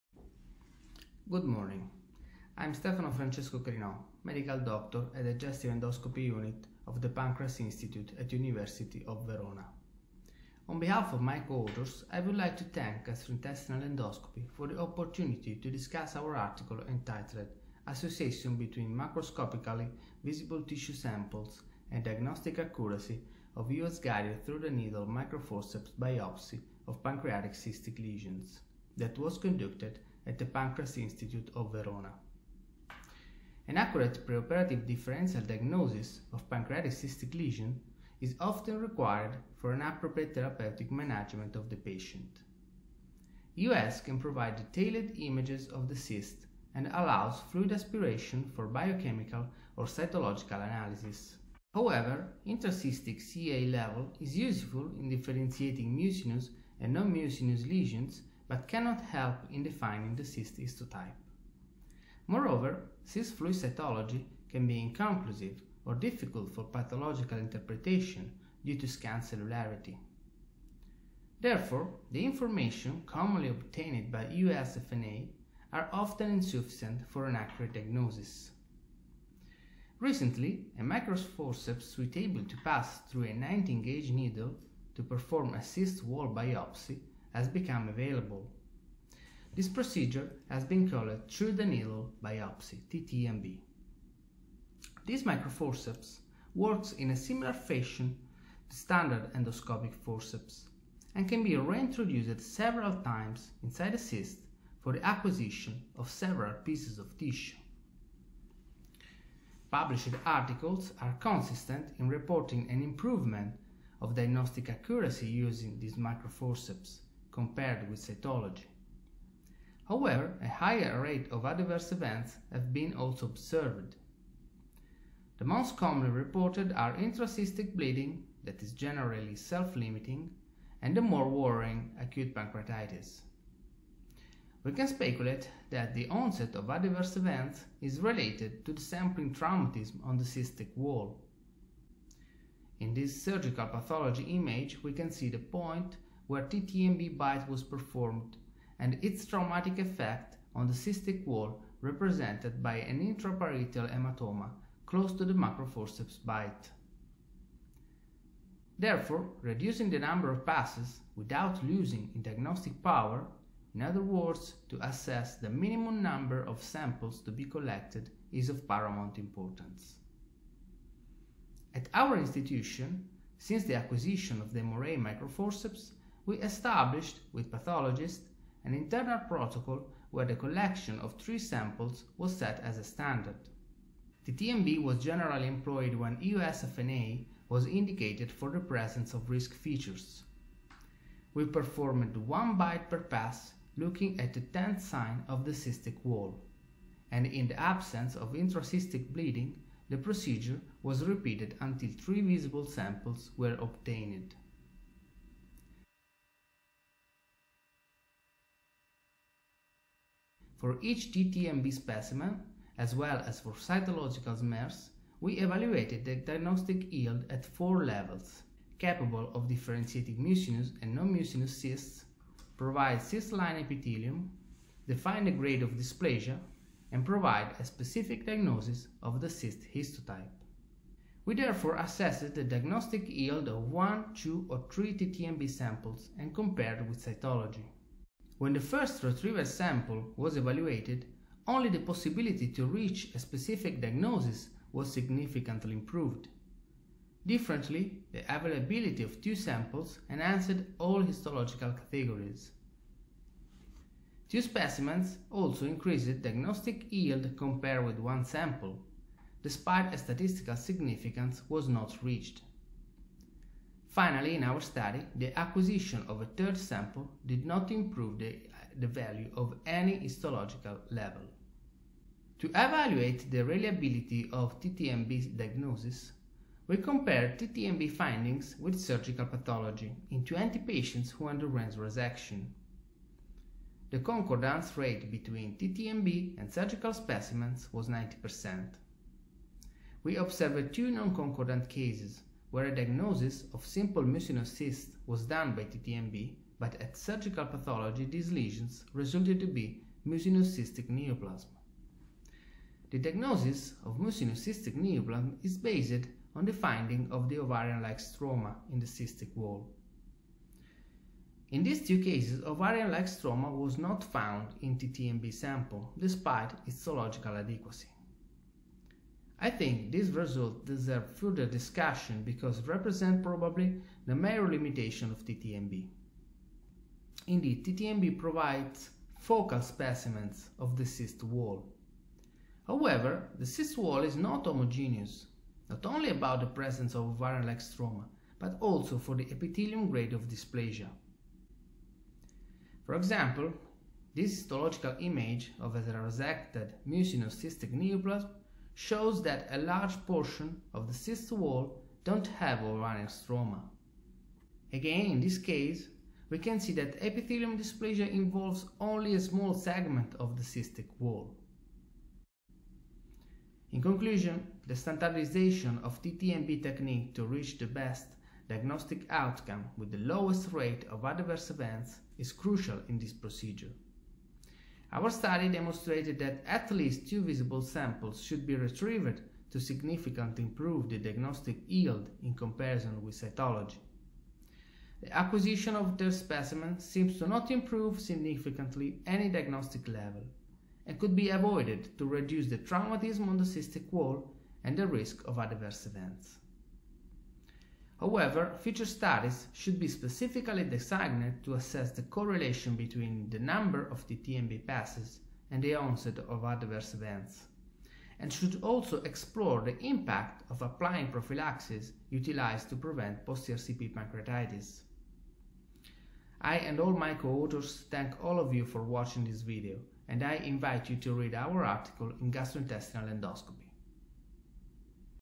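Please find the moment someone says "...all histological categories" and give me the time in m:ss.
4:10.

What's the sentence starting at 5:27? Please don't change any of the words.
Indeed, TTNB provides focal specimens of the cyst wall.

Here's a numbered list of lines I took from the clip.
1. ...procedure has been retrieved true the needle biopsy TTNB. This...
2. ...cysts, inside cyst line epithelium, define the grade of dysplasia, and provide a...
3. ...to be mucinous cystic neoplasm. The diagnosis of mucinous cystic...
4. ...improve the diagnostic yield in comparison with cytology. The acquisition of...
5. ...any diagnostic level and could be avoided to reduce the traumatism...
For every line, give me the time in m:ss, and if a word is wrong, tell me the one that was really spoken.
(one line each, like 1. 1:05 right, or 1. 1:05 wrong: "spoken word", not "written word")
1. 1:29 wrong: "called", not "retrieved"
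2. 3:41 wrong: "provide", not "inside"
3. 4:59 right
4. 6:20 right
5. 6:29 right.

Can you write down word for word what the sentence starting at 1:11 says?
Therefore, the information commonly obtained by EUSFNA are often insufficient for an accurate diagnosis.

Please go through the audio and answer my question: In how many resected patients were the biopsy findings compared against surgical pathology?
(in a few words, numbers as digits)
20.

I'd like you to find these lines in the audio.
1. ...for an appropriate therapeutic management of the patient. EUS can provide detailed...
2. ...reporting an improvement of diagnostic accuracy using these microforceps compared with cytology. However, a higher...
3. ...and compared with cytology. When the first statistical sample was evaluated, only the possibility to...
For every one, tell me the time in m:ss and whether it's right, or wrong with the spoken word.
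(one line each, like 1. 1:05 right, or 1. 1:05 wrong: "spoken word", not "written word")
1. 0:39 right
2. 1:52 right
3. 3:56 wrong: "retrieval", not "statistical".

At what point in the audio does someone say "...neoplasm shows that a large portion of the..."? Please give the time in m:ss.
5:47.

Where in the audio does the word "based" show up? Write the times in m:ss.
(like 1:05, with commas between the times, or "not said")
5:05.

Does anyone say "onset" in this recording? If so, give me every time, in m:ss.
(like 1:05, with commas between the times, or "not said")
2:16, 6:45.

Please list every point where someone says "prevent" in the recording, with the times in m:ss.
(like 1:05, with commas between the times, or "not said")
6:52.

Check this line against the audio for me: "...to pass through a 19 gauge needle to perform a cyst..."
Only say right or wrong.
right.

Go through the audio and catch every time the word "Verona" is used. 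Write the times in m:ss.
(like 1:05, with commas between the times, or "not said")
0:09, 0:31.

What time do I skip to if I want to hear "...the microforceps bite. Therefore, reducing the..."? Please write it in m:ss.
2:35.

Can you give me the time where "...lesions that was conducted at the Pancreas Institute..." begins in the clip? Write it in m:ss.
0:27.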